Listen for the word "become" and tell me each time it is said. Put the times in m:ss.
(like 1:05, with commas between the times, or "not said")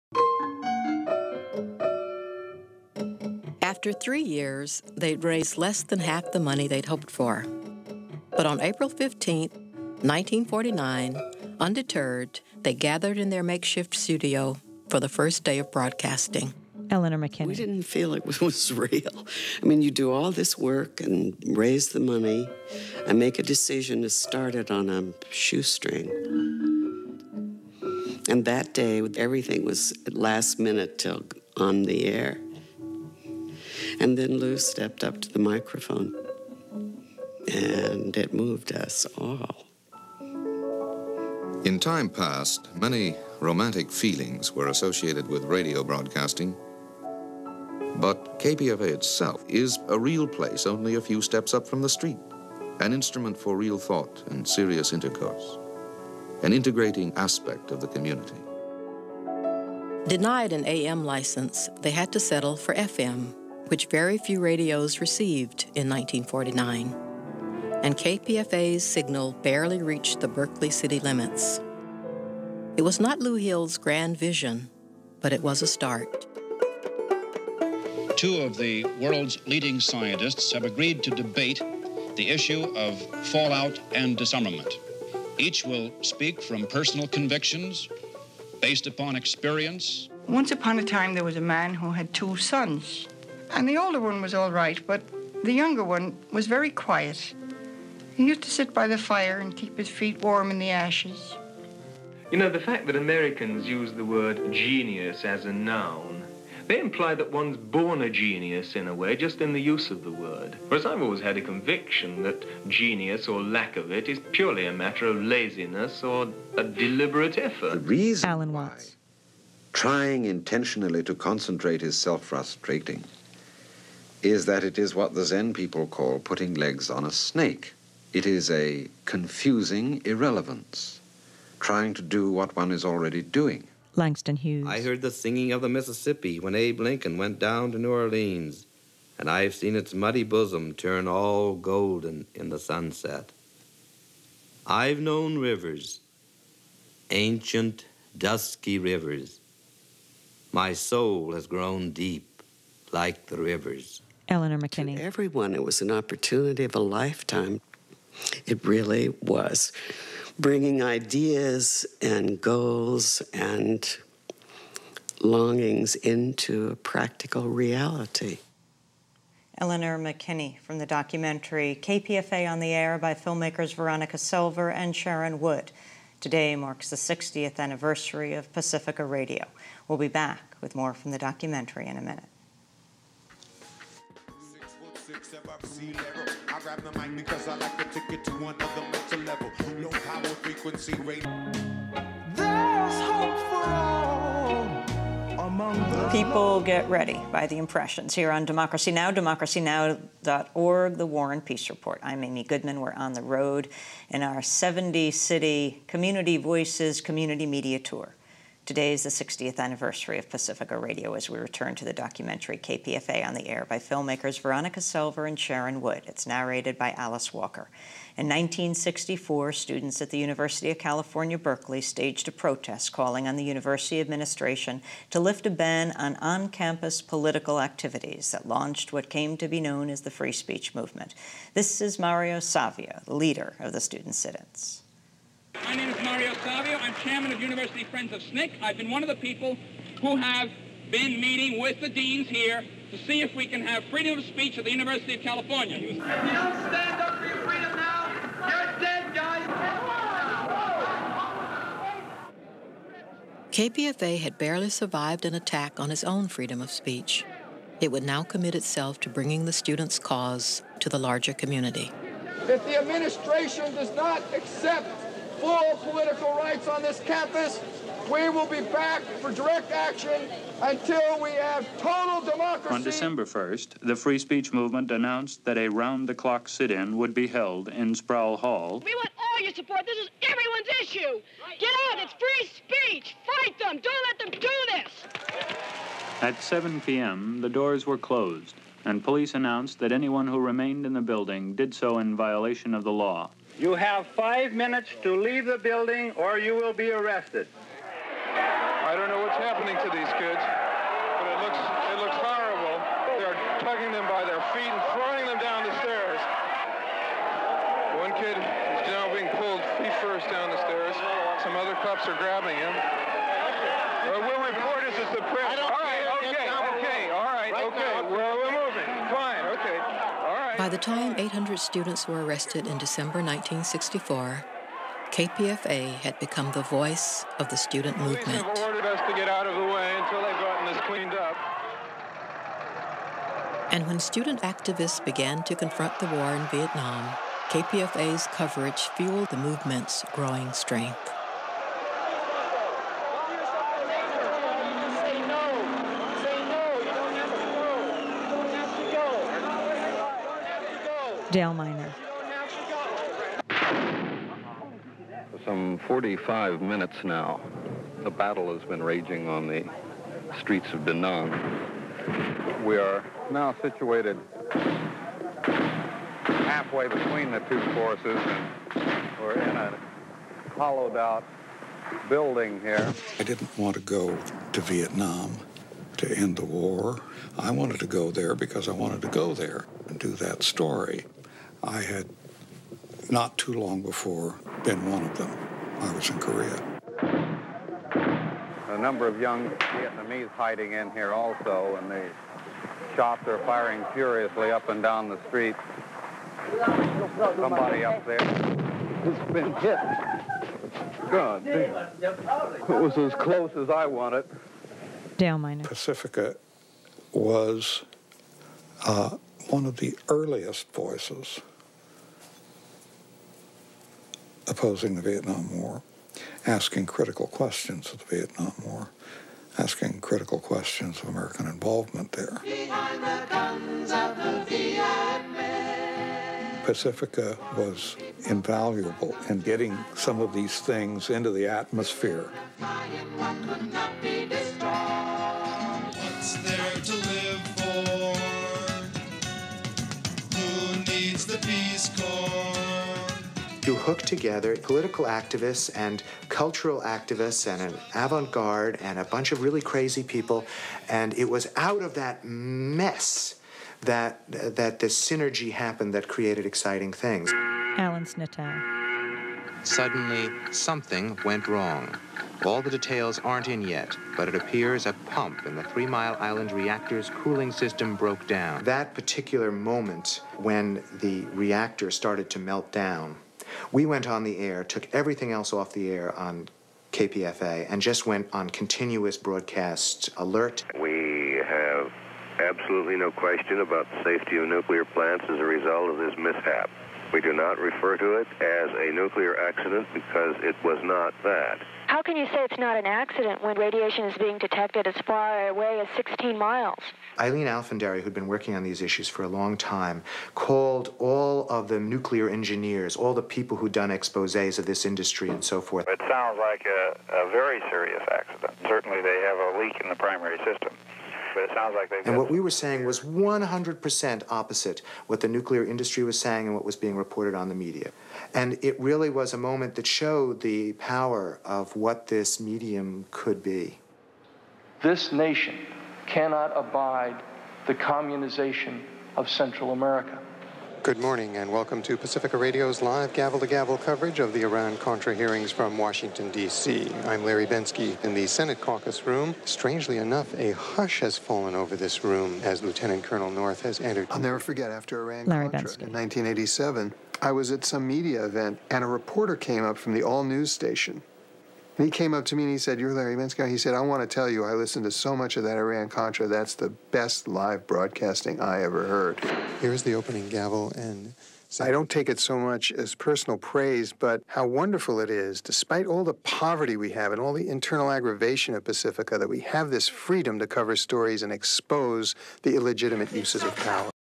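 5:26.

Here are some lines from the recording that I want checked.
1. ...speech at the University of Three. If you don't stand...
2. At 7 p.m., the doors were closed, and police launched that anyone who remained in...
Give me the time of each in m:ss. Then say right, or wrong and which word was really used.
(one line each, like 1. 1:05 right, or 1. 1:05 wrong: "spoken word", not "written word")
1. 4:04 wrong: "California", not "Three"
2. 4:46 wrong: "announced", not "launched".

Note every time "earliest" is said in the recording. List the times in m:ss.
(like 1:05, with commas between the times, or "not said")
6:50.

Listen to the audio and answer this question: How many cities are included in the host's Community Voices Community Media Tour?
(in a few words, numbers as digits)
70.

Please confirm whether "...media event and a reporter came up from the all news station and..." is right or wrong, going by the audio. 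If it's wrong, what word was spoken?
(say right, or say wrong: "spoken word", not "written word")
right.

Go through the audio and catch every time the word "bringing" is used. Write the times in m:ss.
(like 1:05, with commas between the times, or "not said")
2:40, 4:19.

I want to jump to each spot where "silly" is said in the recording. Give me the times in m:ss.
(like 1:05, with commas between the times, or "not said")
not said.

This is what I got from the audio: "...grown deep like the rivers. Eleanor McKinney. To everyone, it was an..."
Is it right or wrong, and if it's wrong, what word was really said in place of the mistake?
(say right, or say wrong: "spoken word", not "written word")
right.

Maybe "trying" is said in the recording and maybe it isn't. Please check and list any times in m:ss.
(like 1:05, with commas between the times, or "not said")
1:59, 2:11.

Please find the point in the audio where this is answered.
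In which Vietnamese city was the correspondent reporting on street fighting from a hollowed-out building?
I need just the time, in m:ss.
6:00.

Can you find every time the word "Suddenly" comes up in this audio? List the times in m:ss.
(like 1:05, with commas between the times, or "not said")
7:39.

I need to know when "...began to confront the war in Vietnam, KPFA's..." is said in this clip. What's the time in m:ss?
5:35.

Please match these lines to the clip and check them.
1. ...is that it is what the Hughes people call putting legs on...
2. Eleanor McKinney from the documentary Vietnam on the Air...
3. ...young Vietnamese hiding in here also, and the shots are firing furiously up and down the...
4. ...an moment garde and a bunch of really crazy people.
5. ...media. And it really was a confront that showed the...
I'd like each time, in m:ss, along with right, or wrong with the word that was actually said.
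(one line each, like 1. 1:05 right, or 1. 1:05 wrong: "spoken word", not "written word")
1. 2:04 wrong: "Zen", not "Hughes"
2. 2:49 wrong: "KPFA", not "Vietnam"
3. 6:29 right
4. 7:27 wrong: "avant", not "moment"
5. 8:37 wrong: "moment", not "confront".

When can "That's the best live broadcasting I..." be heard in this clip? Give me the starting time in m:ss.
9:16.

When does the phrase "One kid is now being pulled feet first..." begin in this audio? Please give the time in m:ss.
5:08.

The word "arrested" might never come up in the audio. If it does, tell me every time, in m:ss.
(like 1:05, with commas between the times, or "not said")
4:56, 5:22.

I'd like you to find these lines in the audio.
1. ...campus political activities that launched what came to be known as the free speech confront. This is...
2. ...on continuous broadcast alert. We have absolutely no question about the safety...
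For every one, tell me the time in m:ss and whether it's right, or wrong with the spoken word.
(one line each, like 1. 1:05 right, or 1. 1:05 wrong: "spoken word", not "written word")
1. 3:46 wrong: "movement", not "confront"
2. 7:58 right.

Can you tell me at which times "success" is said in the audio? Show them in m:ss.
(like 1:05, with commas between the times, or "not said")
not said.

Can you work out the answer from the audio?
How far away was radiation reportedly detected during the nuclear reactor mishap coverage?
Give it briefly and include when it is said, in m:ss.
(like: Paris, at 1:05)
16 miles, at 8:15.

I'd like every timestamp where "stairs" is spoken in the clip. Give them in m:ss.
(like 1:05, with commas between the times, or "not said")
5:05, 5:10.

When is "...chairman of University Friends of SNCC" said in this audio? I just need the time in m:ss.
3:56.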